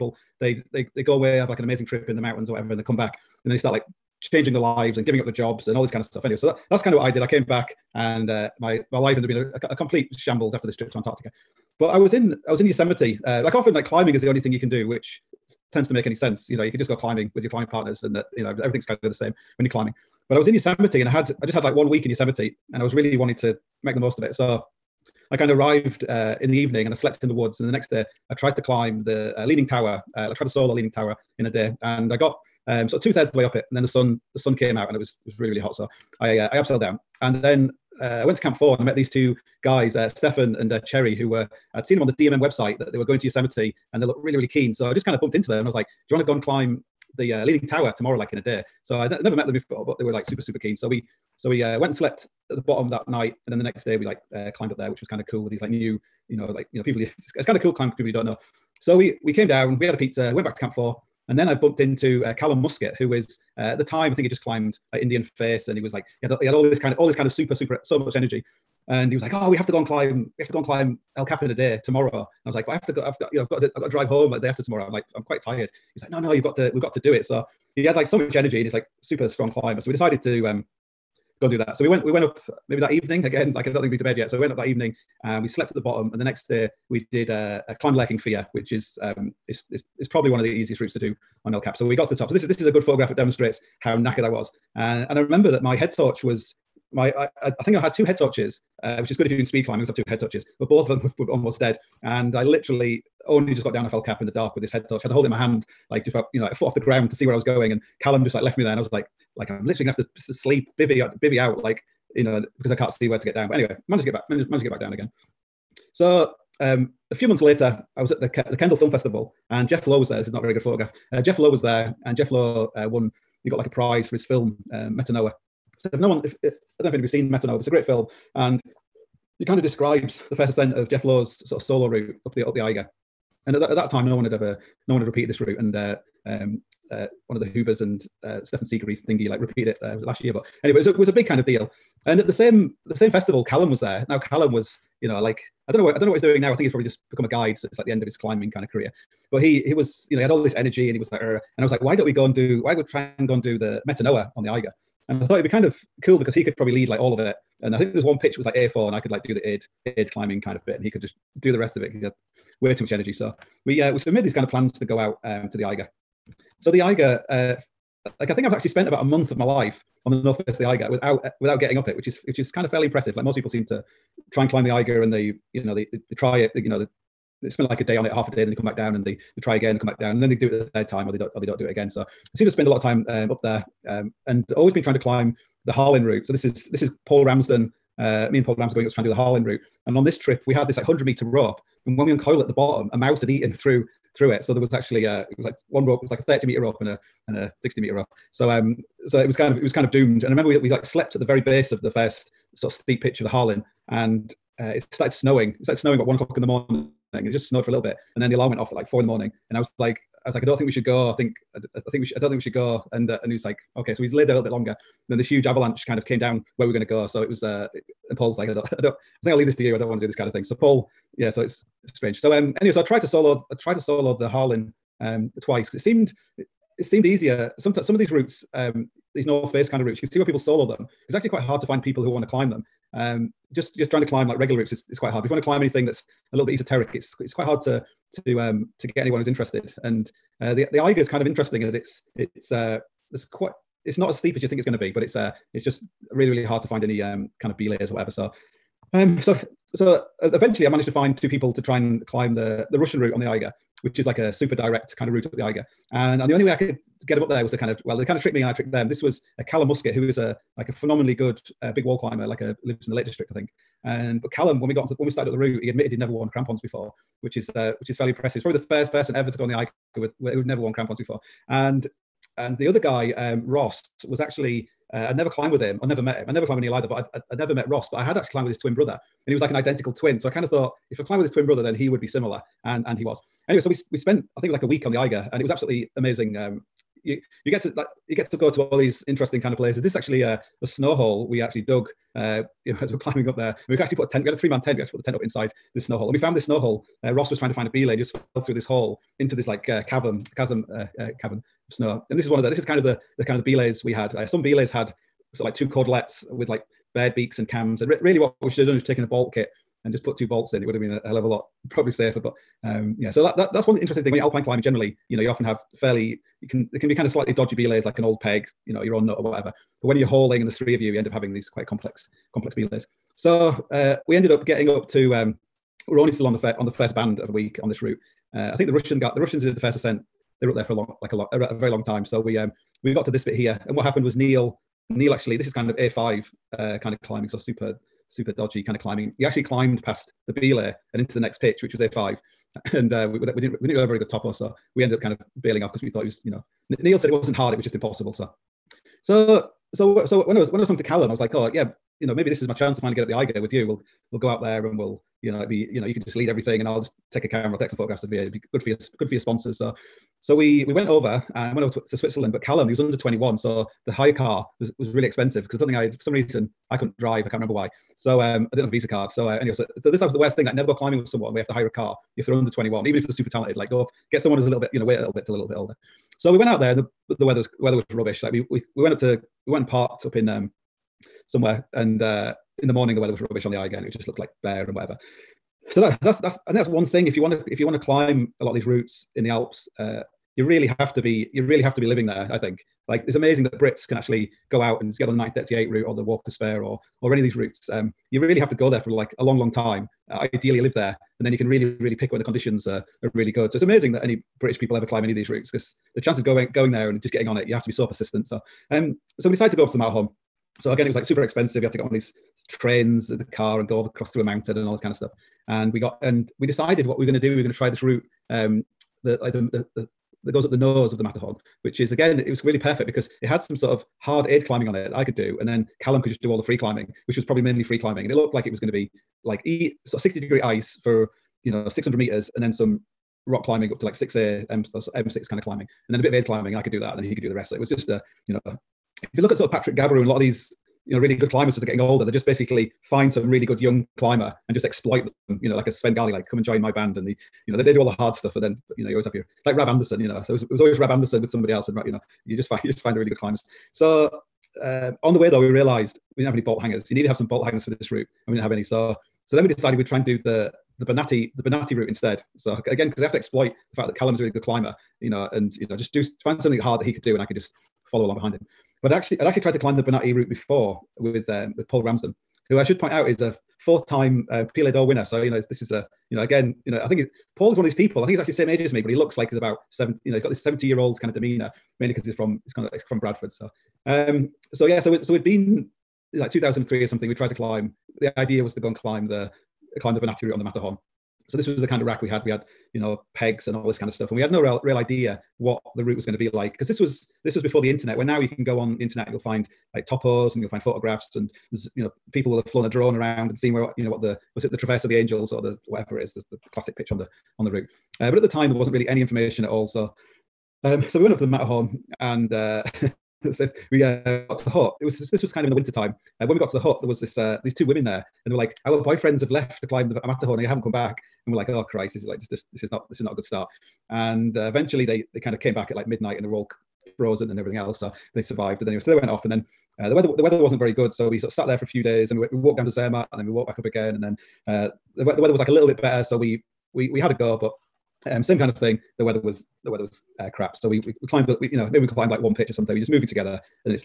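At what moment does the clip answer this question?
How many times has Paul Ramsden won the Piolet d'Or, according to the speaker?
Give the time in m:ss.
7:53.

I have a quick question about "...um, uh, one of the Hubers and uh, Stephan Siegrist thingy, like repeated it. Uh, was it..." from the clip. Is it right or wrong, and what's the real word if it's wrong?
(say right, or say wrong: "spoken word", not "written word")
right.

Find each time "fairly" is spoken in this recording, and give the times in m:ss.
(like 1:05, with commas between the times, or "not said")
2:52, 4:27, 5:15.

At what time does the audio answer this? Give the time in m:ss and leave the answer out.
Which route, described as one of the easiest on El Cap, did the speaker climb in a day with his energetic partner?
1:27.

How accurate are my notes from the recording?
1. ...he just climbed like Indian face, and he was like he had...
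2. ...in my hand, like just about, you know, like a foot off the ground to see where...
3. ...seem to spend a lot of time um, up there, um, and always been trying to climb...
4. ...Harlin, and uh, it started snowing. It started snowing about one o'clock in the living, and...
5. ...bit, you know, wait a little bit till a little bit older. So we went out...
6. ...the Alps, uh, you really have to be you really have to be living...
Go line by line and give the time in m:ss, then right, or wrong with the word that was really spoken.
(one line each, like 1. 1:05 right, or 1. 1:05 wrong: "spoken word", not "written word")
1. 1:04 right
2. 1:45 right
3. 3:02 right
4. 3:23 wrong: "morning", not "living"
5. 6:14 right
6. 6:29 right.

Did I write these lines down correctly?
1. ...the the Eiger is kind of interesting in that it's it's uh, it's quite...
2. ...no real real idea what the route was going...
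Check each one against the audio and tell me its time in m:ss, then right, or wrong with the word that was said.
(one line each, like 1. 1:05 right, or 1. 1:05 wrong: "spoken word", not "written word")
1. 4:00 right
2. 8:14 right.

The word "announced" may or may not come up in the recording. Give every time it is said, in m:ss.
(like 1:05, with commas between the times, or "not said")
not said.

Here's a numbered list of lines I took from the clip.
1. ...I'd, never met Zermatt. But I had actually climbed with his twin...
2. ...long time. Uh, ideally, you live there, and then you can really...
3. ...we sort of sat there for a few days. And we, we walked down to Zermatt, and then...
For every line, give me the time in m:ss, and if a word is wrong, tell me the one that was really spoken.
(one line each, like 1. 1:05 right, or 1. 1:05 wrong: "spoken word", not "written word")
1. 4:37 wrong: "Ross", not "Zermatt"
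2. 6:39 right
3. 8:51 right.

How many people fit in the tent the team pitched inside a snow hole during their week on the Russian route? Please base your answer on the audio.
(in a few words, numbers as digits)
3.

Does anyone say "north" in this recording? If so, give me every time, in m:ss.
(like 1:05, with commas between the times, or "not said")
2:50, 3:49.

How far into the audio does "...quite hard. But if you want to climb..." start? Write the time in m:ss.
3:54.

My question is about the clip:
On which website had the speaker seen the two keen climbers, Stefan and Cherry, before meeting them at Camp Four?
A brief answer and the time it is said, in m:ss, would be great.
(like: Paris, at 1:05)
DMM, at 0:42.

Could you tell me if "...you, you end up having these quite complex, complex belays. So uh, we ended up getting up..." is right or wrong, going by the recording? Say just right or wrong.
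right.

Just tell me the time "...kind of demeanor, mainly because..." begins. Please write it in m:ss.
8:00.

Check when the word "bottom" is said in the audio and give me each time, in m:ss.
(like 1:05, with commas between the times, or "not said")
0:52, 1:25, 3:12.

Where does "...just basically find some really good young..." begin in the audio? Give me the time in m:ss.
7:22.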